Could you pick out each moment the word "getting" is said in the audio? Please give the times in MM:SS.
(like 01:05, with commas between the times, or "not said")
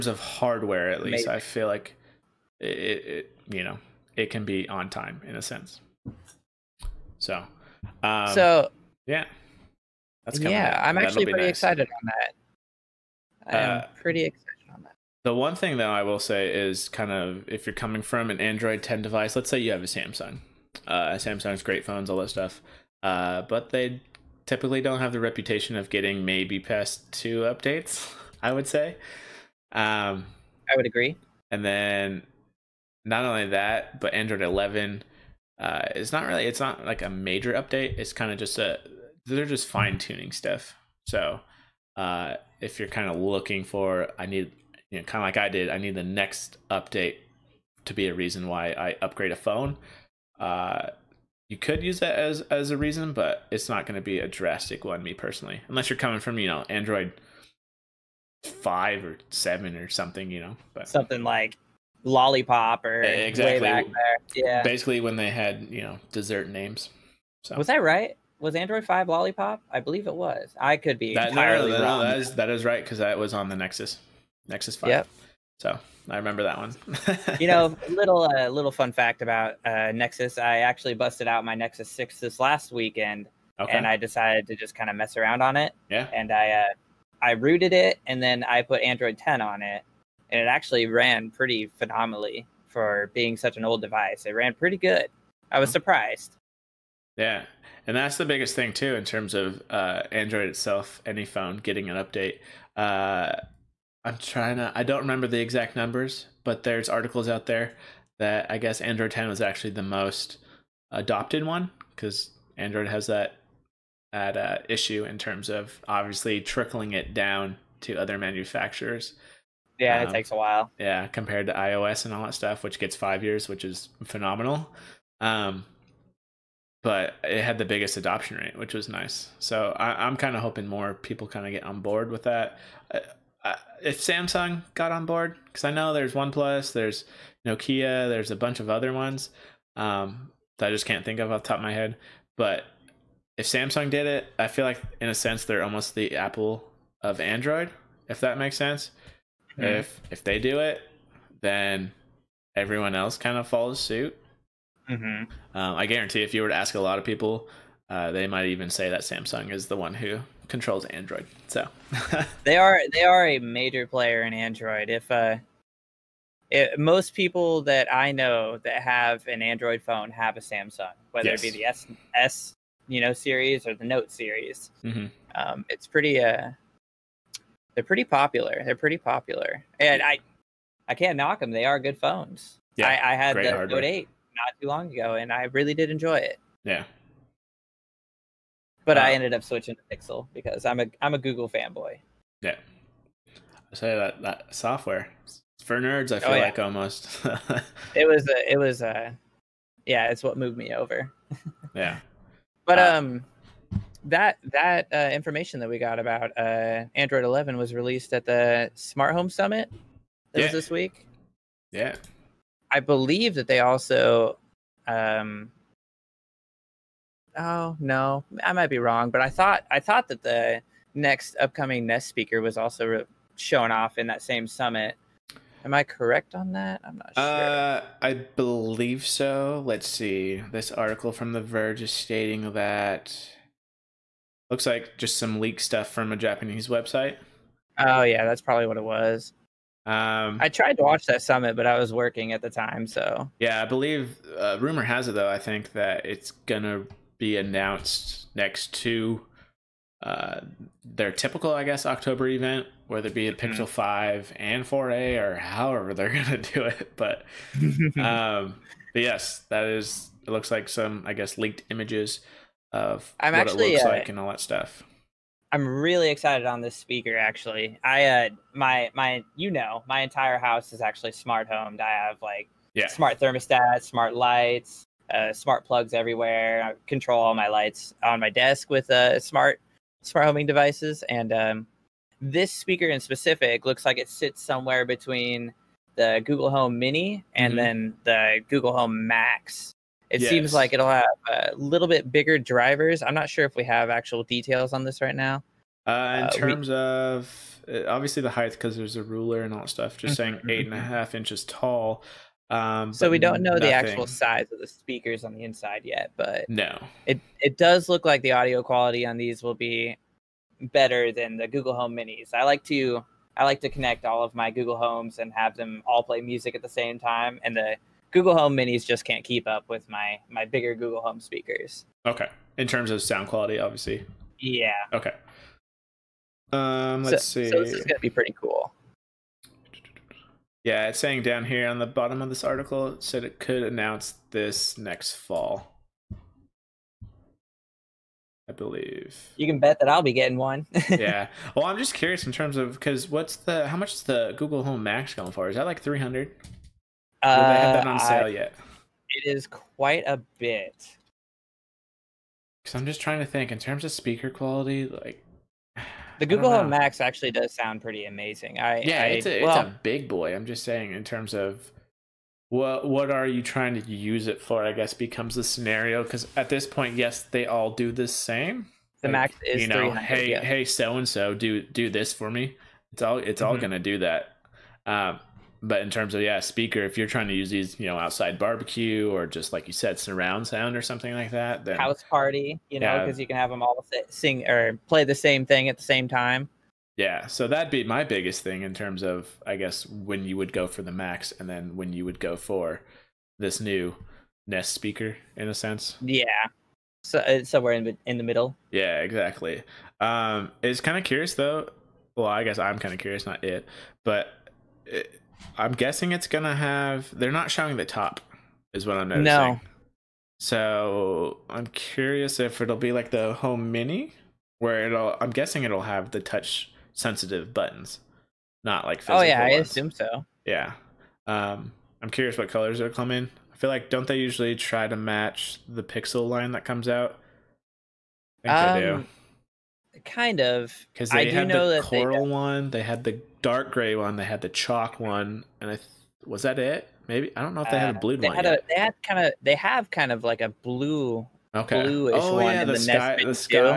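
00:25, 01:41, 05:40.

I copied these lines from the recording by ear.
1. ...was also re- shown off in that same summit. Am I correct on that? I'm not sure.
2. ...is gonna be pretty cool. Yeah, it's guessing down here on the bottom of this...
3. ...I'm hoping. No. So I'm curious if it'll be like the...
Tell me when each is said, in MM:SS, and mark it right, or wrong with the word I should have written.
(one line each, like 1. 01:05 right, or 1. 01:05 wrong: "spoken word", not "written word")
1. 03:42 right
2. 05:27 wrong: "saying", not "guessing"
3. 06:48 wrong: "noticing", not "hoping".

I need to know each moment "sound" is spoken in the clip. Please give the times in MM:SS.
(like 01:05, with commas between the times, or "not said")
05:23, 05:57, 06:20.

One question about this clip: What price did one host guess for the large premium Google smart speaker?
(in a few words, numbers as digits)
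300.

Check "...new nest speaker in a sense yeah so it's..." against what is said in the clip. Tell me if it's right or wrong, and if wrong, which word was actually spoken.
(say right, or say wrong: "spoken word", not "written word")
right.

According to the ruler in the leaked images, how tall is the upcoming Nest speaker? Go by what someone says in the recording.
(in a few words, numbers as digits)
8.5 inches.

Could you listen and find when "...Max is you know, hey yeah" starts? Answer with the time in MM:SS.
06:09.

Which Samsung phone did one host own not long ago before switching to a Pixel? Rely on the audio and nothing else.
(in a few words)
Note 8.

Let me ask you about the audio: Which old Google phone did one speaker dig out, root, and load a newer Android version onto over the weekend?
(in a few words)
Nexus 6.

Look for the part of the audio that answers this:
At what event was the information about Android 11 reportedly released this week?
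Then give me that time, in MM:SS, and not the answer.
03:28.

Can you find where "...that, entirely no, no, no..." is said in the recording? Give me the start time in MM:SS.
01:11.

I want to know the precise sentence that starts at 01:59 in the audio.
Yeah, um, it takes a while.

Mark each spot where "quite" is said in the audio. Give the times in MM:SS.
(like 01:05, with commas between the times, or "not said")
05:49.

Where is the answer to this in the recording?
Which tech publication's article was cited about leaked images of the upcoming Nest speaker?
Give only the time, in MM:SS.
03:51.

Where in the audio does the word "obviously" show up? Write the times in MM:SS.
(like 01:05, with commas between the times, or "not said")
01:55, 04:57, 05:23.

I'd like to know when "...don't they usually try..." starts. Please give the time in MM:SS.
07:03.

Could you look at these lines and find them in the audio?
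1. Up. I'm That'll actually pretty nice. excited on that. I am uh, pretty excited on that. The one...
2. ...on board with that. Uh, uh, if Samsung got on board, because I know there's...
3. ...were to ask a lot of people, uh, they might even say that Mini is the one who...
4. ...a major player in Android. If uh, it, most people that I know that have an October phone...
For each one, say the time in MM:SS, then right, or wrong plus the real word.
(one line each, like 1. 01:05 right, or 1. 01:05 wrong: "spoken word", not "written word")
1. 00:10 right
2. 02:11 right
3. 02:36 wrong: "Samsung", not "Mini"
4. 02:43 wrong: "Android", not "October".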